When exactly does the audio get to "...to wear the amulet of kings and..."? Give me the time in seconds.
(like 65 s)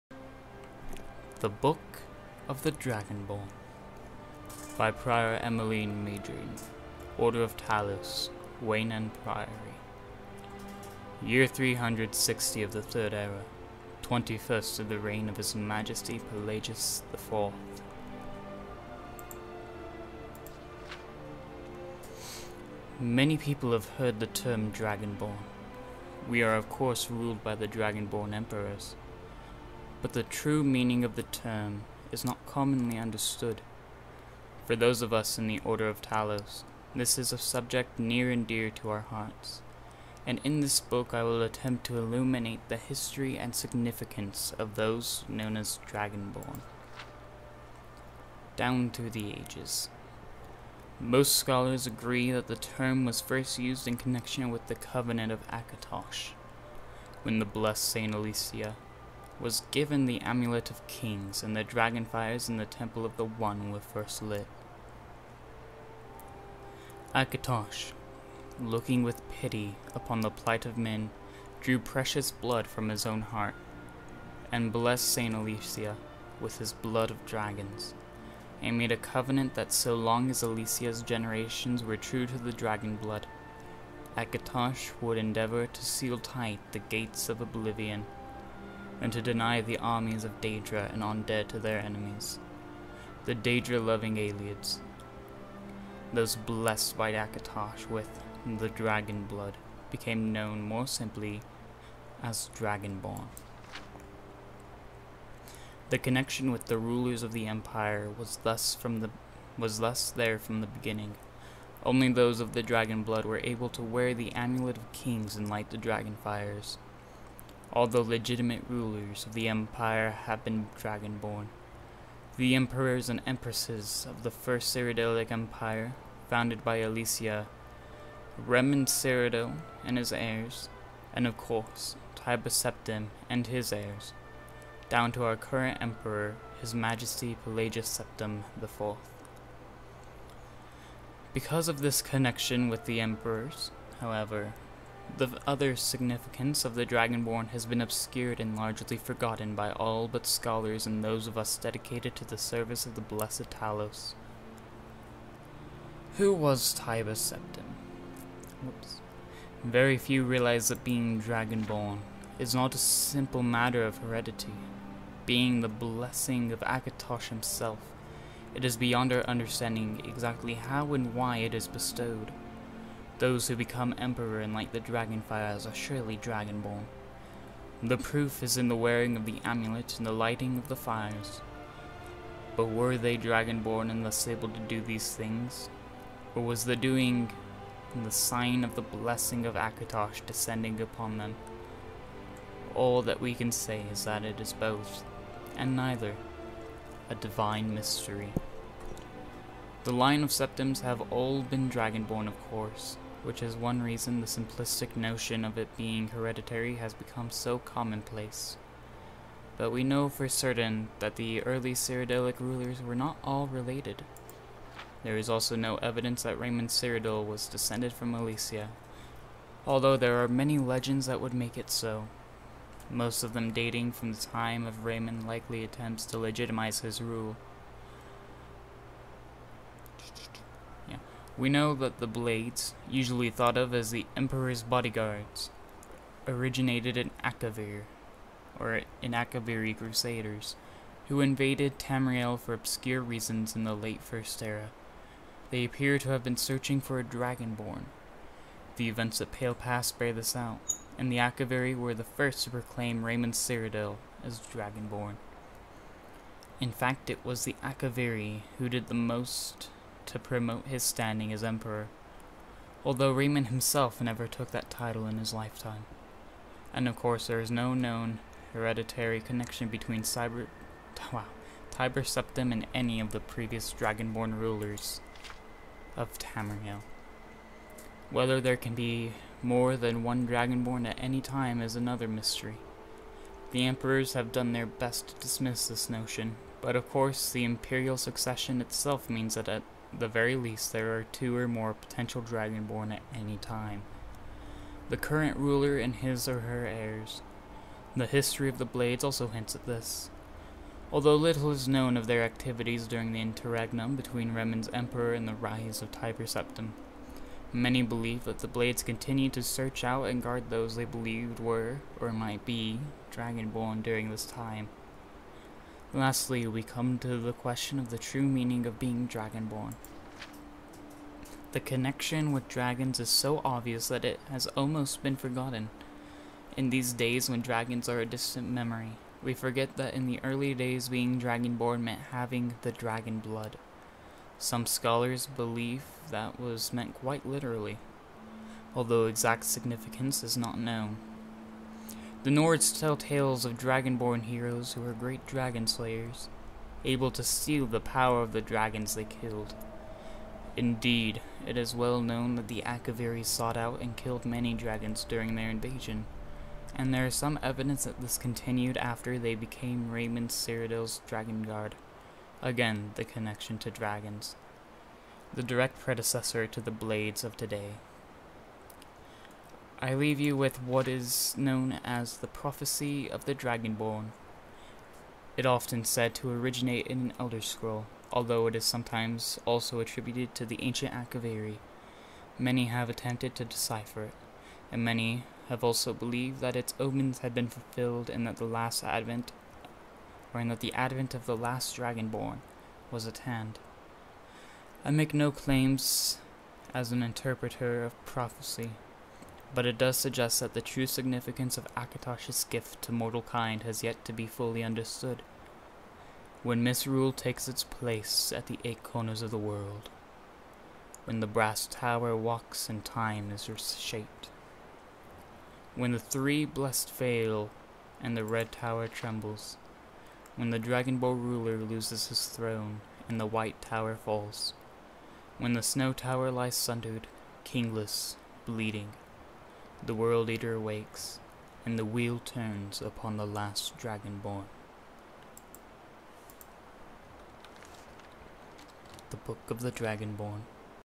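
113 s.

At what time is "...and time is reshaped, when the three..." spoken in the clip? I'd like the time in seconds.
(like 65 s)
412 s.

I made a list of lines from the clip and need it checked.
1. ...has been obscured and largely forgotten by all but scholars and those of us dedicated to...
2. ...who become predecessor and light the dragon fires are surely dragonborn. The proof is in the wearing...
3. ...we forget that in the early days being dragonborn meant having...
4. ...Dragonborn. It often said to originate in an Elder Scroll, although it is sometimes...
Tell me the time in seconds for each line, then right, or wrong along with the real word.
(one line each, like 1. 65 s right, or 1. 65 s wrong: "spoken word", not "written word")
1. 147 s right
2. 173 s wrong: "emperor", not "predecessor"
3. 329 s right
4. 373 s right.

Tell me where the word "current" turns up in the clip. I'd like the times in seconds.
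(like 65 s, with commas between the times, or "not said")
135 s, 294 s.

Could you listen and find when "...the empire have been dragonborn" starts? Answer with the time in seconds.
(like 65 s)
119 s.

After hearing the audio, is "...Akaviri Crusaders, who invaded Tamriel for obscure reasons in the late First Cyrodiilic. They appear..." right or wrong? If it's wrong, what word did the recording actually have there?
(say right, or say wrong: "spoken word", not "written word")
wrong: "Era", not "Cyrodiilic".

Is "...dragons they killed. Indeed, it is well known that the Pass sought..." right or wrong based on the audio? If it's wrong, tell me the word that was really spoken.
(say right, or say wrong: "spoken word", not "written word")
wrong: "Akaviri", not "Pass".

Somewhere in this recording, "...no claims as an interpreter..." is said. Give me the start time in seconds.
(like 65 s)
395 s.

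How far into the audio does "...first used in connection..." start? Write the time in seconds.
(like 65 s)
53 s.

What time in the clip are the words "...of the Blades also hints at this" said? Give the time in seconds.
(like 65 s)
298 s.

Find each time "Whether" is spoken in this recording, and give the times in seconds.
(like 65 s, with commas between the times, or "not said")
278 s.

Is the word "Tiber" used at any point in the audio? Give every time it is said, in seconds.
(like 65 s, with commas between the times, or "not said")
132 s, 271 s, 305 s.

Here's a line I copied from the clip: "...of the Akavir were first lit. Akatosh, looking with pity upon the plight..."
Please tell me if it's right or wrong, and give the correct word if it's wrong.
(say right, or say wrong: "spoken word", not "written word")
wrong: "One", not "Akavir".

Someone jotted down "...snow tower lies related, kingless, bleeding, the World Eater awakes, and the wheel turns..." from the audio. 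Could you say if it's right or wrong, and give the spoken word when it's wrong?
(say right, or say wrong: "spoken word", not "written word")
wrong: "sundered", not "related".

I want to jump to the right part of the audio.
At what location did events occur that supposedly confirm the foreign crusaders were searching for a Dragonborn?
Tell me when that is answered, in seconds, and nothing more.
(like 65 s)
249 s.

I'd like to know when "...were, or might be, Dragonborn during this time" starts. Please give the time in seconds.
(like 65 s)
311 s.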